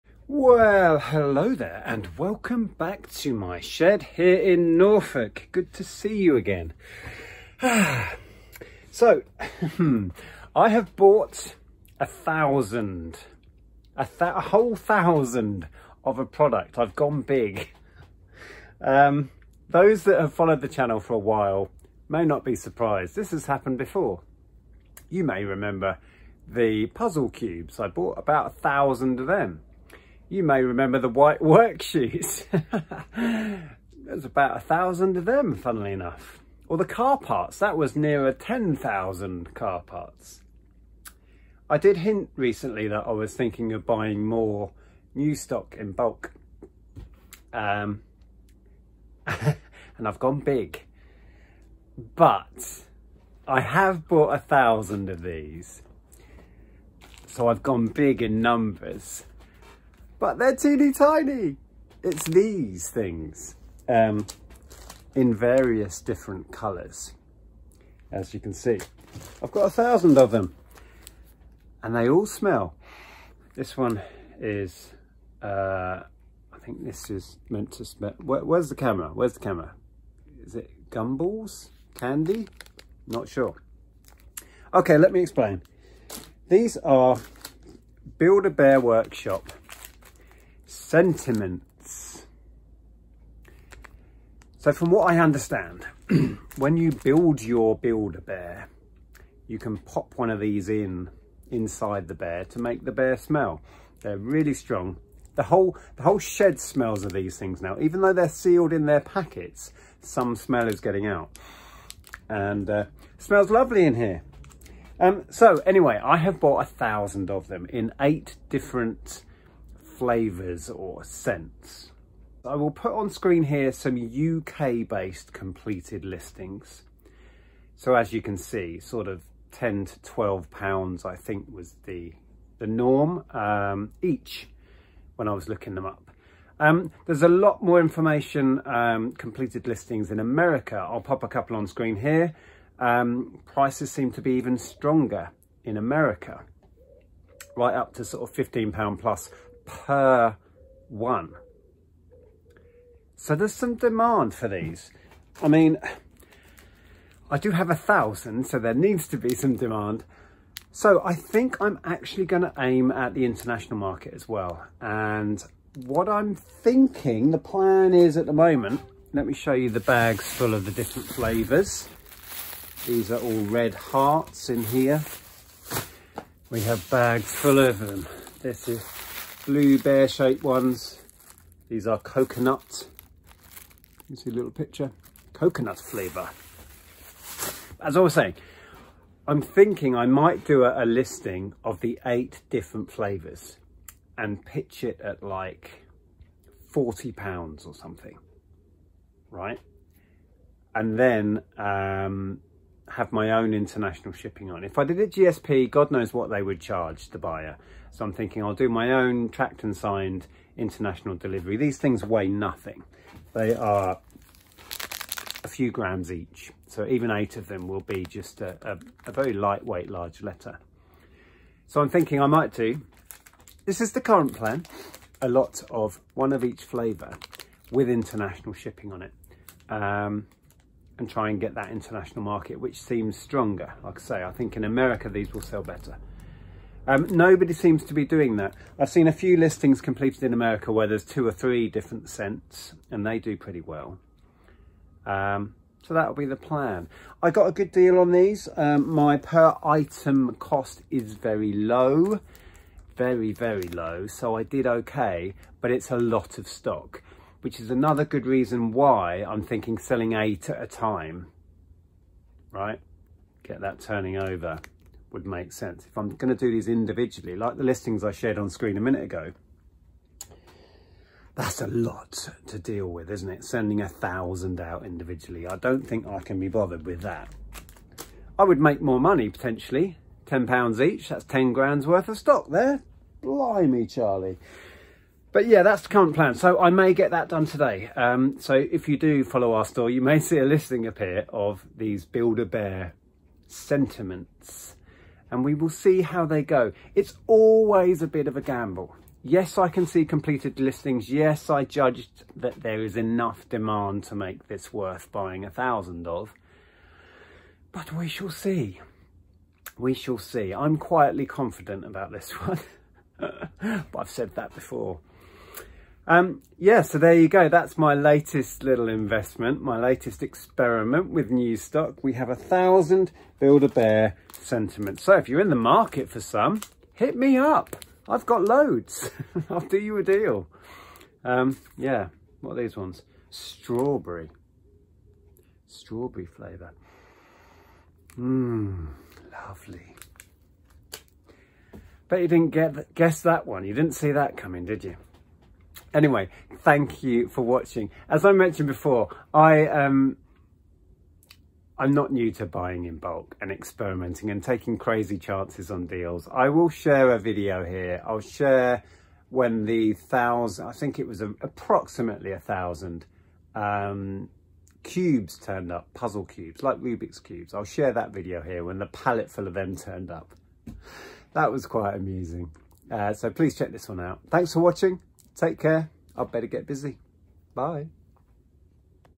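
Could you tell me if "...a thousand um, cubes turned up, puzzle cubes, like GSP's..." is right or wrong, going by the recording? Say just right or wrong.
wrong.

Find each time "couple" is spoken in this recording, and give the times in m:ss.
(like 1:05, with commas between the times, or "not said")
2:21.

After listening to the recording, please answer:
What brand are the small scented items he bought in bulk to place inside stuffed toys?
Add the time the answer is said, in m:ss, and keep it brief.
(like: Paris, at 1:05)
Build-A-Bear Workshop, at 1:28.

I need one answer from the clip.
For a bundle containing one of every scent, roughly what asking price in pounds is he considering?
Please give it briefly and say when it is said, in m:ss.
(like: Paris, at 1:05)
£40, at 3:16.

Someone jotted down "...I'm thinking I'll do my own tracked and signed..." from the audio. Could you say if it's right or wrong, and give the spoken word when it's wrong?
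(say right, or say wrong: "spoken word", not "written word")
right.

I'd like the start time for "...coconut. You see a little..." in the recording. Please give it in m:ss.
3:01.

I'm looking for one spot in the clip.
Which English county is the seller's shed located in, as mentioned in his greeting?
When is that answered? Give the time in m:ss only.
0:04.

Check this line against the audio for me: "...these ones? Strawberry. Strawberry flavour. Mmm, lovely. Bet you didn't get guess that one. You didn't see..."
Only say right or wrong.
right.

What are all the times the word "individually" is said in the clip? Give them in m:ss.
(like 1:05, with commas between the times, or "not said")
4:26, 4:34.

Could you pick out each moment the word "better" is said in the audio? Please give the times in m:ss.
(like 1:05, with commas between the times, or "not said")
3:55, 6:16.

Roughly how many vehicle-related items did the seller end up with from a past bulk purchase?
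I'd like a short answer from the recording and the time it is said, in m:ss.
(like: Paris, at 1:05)
10,000, at 0:38.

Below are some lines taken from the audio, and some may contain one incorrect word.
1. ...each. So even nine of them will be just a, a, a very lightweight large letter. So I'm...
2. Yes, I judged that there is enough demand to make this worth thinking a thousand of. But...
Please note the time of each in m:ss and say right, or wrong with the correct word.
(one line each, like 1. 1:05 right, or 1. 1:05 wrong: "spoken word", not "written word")
1. 3:36 wrong: "eight", not "nine"
2. 5:01 wrong: "buying", not "thinking".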